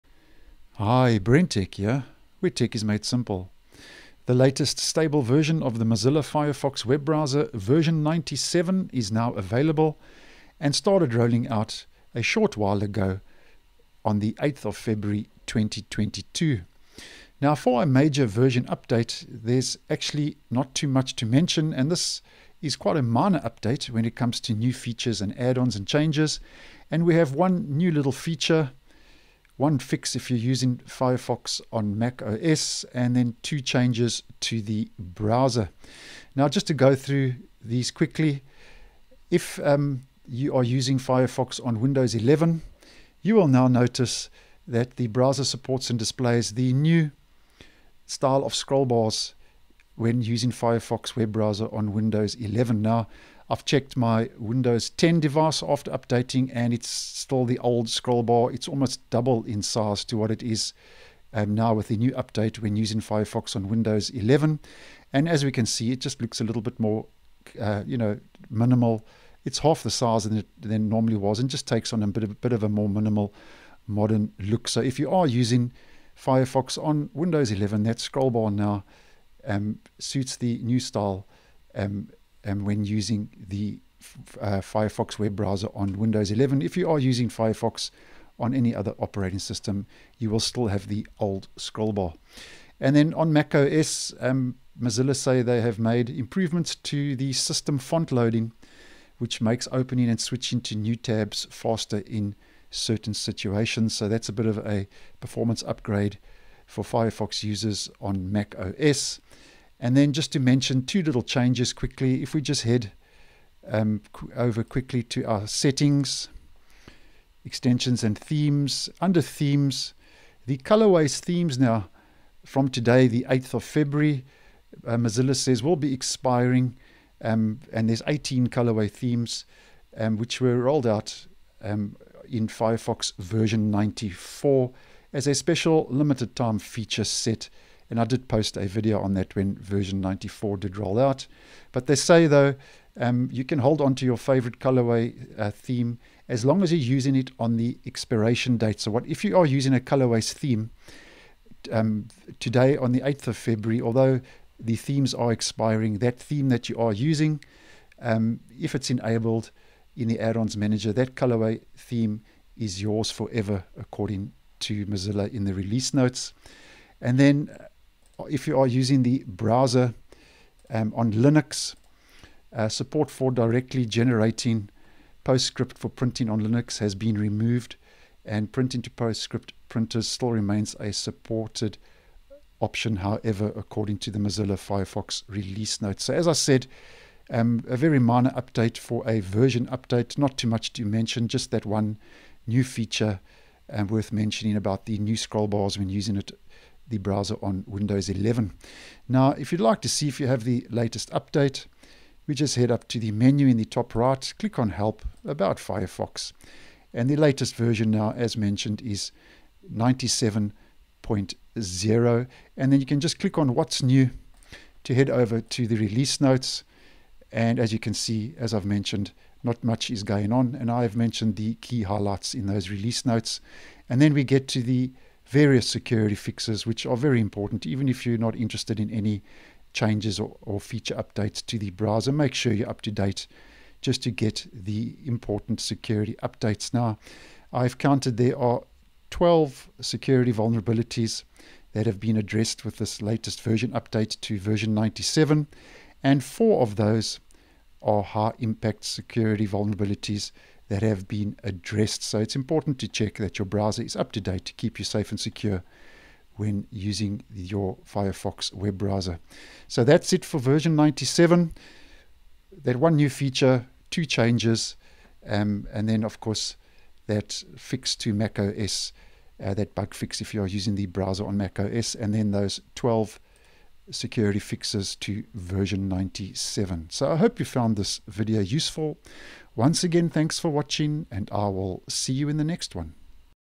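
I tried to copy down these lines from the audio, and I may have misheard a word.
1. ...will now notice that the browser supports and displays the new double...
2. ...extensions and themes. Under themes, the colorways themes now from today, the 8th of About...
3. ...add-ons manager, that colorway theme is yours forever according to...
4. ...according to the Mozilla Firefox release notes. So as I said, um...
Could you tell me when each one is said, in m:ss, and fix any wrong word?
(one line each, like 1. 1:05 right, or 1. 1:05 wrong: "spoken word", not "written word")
1. 0:43 wrong: "style", not "double"
2. 1:57 wrong: "February", not "About"
3. 2:40 right
4. 3:03 right.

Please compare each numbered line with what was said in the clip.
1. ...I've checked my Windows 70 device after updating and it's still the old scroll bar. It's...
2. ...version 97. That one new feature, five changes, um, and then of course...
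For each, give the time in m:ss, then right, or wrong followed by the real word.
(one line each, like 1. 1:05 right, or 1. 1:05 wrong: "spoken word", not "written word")
1. 0:53 wrong: "10", not "70"
2. 4:20 wrong: "two", not "five".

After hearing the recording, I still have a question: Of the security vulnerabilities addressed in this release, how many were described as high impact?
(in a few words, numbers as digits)
4.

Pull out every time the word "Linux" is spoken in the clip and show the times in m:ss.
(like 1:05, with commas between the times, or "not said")
2:51, 2:56.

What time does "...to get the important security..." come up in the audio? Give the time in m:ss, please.
3:54.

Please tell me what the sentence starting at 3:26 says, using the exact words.
And the latest version now, as mentioned, is 97.0.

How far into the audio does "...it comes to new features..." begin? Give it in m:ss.
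0:24.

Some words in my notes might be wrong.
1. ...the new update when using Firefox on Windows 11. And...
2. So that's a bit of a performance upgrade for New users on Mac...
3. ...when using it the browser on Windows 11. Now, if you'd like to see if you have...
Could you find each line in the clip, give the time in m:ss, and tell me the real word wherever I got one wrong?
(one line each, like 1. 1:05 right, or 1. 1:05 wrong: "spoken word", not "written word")
1. 1:01 right
2. 1:43 wrong: "Firefox", not "New"
3. 3:15 right.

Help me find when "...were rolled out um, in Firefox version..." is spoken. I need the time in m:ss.
2:10.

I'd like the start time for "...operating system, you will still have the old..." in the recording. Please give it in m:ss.
1:28.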